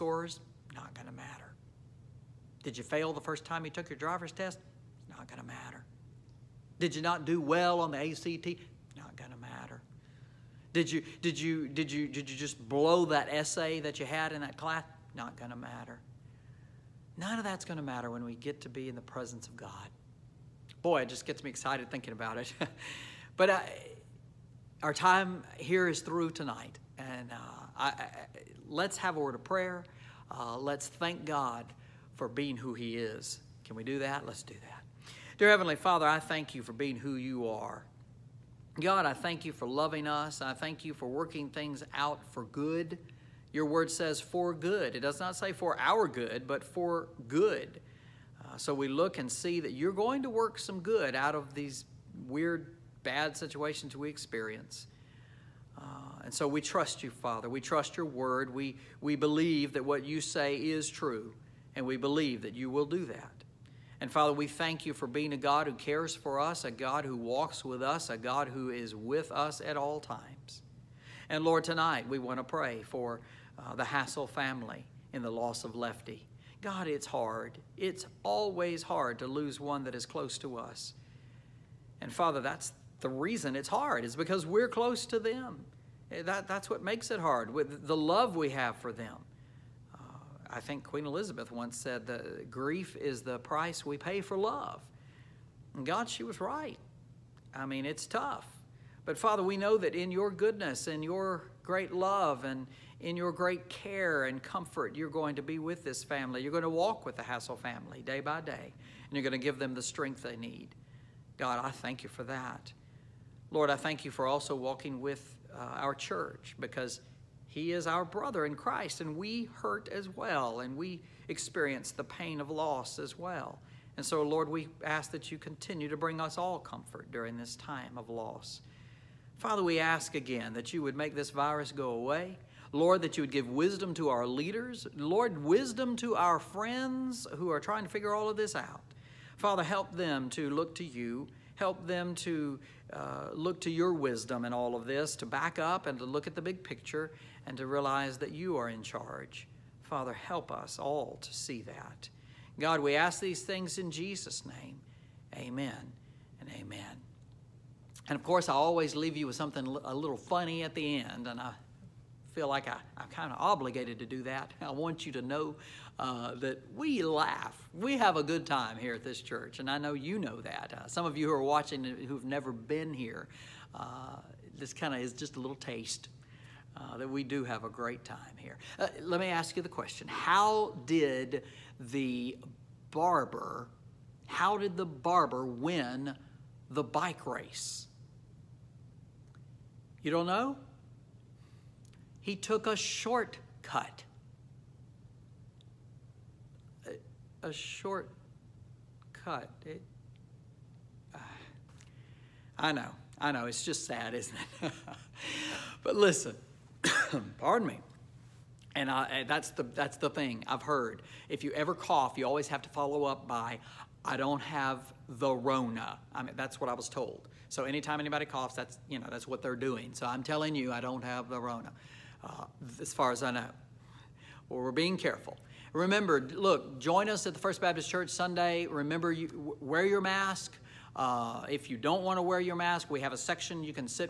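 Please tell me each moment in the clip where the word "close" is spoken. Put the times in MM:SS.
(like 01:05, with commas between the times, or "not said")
01:20, 01:24.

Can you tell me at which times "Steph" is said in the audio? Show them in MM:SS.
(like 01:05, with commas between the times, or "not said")
not said.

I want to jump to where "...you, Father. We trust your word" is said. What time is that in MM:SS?
00:57.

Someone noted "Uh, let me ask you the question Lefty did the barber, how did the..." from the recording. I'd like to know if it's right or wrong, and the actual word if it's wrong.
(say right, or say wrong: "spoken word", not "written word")
wrong: "How", not "Lefty".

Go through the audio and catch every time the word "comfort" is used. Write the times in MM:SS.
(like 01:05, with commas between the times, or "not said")
01:44, 02:06.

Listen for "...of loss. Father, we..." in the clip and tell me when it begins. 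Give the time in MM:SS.
02:07.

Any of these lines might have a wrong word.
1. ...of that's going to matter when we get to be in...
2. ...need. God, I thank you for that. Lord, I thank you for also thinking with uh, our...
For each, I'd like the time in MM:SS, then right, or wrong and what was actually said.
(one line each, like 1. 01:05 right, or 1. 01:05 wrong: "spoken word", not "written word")
1. 00:17 right
2. 01:50 wrong: "walking", not "thinking".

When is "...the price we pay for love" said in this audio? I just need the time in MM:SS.
01:33.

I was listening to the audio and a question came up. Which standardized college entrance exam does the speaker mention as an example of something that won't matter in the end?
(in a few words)
ACT.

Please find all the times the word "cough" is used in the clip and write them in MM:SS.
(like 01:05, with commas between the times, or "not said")
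03:31, 03:38.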